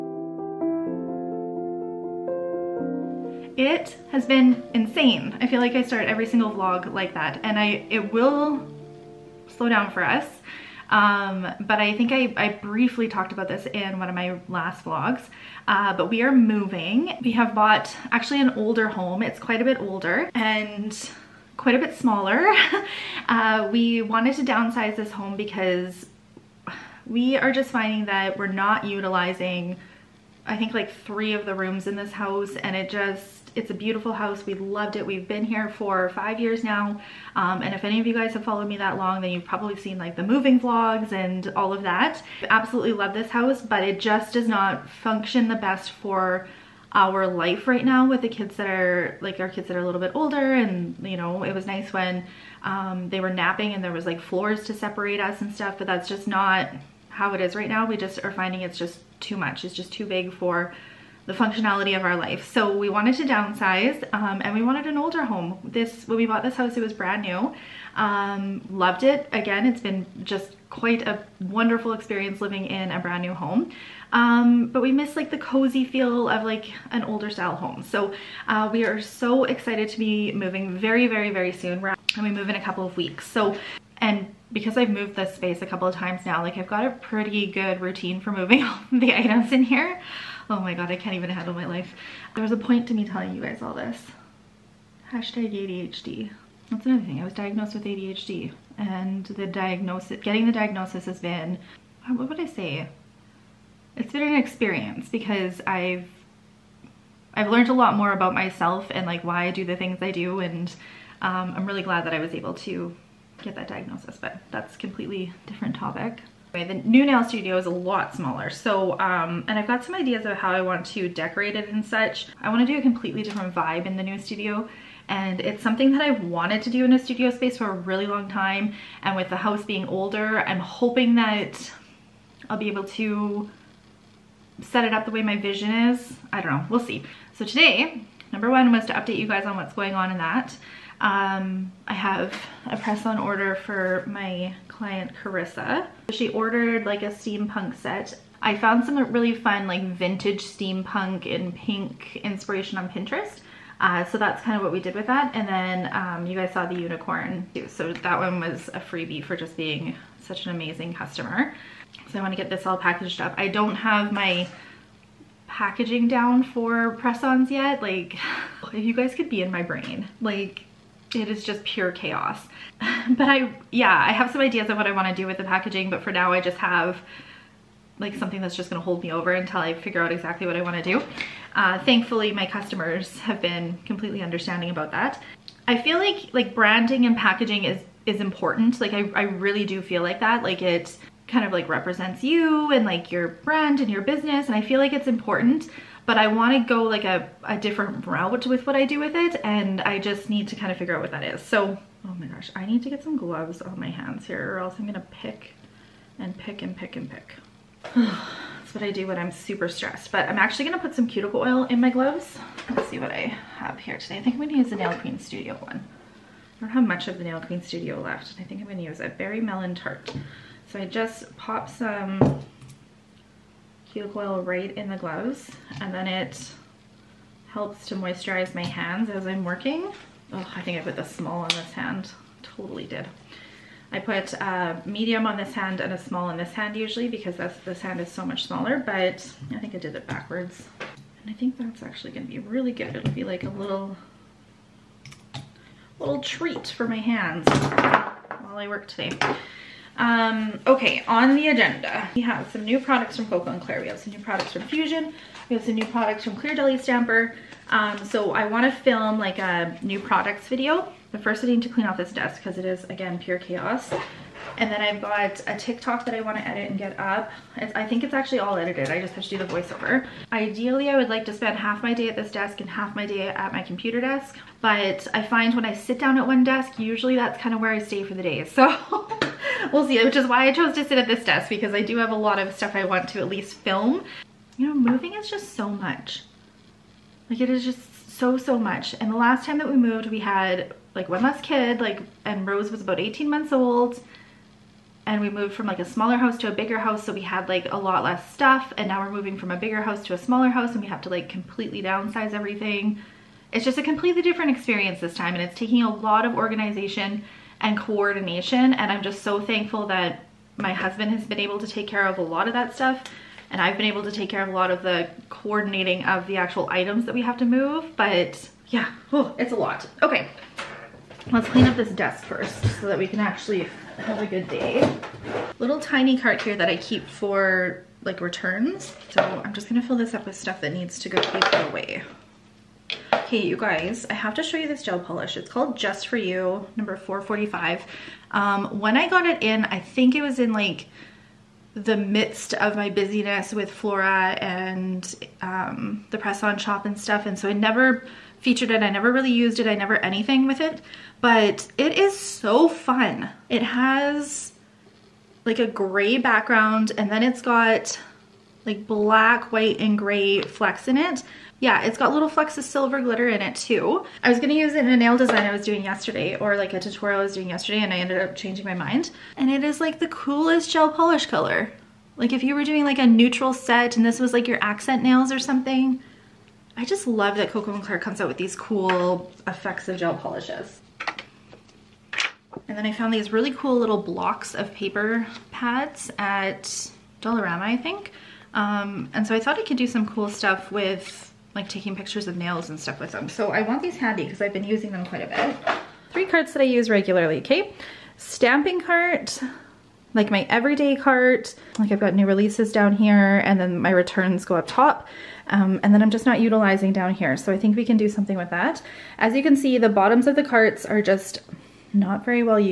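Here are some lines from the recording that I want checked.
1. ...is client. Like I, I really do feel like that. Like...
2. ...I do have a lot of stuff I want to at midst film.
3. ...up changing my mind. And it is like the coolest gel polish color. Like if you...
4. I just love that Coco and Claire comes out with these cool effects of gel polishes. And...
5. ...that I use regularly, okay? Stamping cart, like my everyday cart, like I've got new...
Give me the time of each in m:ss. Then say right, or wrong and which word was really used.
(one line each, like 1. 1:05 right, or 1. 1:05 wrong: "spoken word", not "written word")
1. 3:08 wrong: "important", not "client"
2. 4:41 wrong: "least", not "midst"
3. 6:08 right
4. 6:16 right
5. 6:36 right.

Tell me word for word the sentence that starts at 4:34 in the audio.
But I find when I sit down at one desk, usually that's kind of where I stay for the day.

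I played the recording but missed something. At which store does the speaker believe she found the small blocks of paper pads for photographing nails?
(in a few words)
Dollarama.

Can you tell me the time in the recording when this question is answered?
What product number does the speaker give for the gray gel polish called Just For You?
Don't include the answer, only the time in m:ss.
5:36.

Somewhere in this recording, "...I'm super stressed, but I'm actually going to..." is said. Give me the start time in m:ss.
3:29.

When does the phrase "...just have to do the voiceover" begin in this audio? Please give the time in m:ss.
4:29.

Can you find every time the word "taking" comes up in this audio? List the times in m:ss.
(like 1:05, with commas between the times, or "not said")
5:05, 6:31.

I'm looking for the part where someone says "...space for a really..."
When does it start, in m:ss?
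2:07.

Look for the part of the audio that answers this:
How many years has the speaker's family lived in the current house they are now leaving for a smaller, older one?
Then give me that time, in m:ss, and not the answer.
0:36.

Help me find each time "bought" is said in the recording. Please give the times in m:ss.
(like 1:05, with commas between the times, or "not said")
0:17, 1:06.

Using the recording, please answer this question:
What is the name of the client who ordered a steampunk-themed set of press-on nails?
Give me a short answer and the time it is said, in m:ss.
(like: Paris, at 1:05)
Carissa, at 2:25.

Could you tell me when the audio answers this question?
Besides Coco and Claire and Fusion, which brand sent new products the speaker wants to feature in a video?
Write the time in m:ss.
4:16.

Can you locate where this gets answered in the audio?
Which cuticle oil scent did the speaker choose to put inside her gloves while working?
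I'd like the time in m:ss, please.
3:39.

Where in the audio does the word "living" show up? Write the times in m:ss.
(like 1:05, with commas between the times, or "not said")
1:12.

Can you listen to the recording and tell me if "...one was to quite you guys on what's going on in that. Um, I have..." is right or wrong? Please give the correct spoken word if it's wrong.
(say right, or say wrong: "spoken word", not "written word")
wrong: "update", not "quite".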